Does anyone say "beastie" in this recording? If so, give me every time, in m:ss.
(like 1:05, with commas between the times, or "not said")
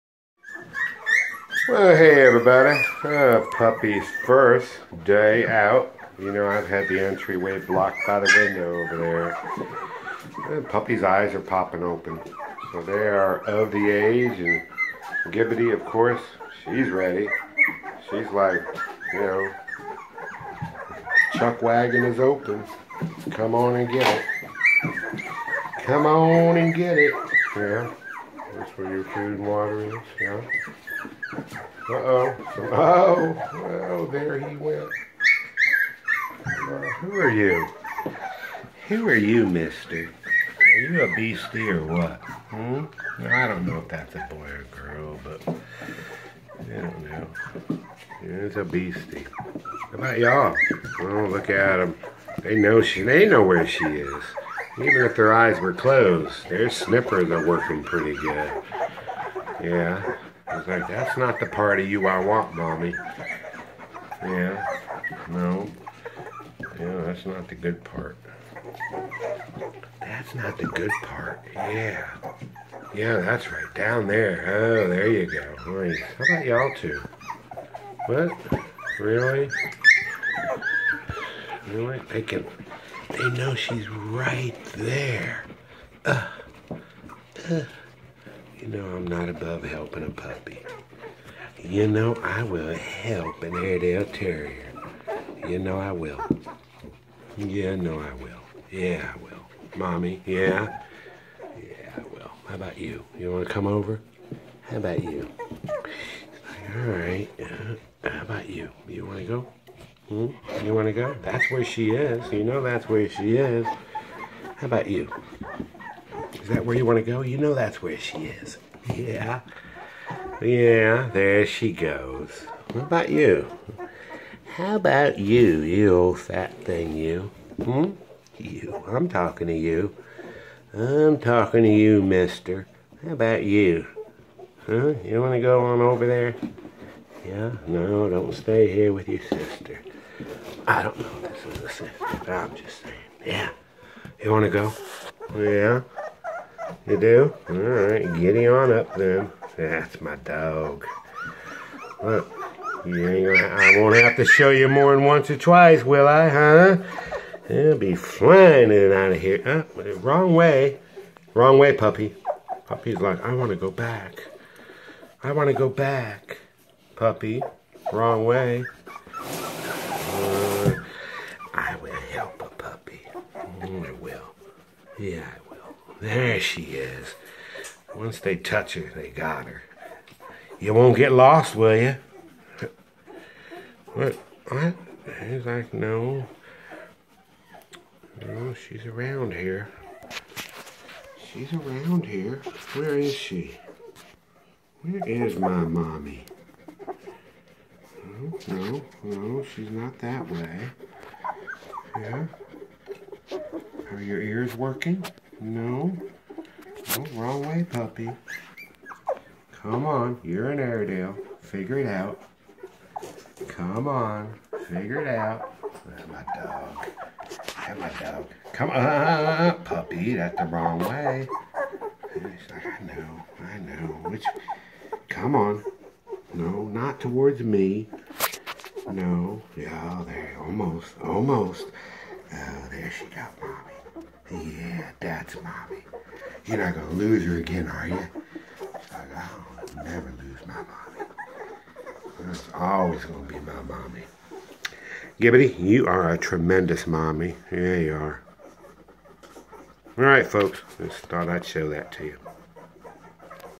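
0:41, 0:48.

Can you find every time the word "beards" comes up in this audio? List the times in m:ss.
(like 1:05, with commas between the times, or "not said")
not said.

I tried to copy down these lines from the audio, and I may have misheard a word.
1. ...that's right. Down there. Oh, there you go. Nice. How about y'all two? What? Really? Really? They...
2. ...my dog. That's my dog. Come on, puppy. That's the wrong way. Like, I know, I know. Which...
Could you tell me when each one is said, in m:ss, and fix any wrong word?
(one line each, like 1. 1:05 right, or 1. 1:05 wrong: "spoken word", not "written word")
1. 1:13 right
2. 3:36 right.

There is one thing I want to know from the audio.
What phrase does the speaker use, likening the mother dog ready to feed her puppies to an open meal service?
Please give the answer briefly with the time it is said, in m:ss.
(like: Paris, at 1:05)
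chuck wagon, at 0:21.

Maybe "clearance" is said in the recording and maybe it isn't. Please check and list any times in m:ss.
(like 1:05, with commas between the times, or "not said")
not said.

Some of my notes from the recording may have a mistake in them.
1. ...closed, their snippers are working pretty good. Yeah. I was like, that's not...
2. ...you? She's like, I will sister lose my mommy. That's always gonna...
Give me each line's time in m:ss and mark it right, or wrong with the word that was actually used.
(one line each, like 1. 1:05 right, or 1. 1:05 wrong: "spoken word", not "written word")
1. 0:55 right
2. 3:57 wrong: "never", not "sister".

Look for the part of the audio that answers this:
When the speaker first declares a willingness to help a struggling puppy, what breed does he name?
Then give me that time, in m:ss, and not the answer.
1:33.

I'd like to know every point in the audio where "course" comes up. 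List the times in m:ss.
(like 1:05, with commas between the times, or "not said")
0:15.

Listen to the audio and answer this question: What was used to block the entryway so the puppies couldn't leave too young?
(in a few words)
the window.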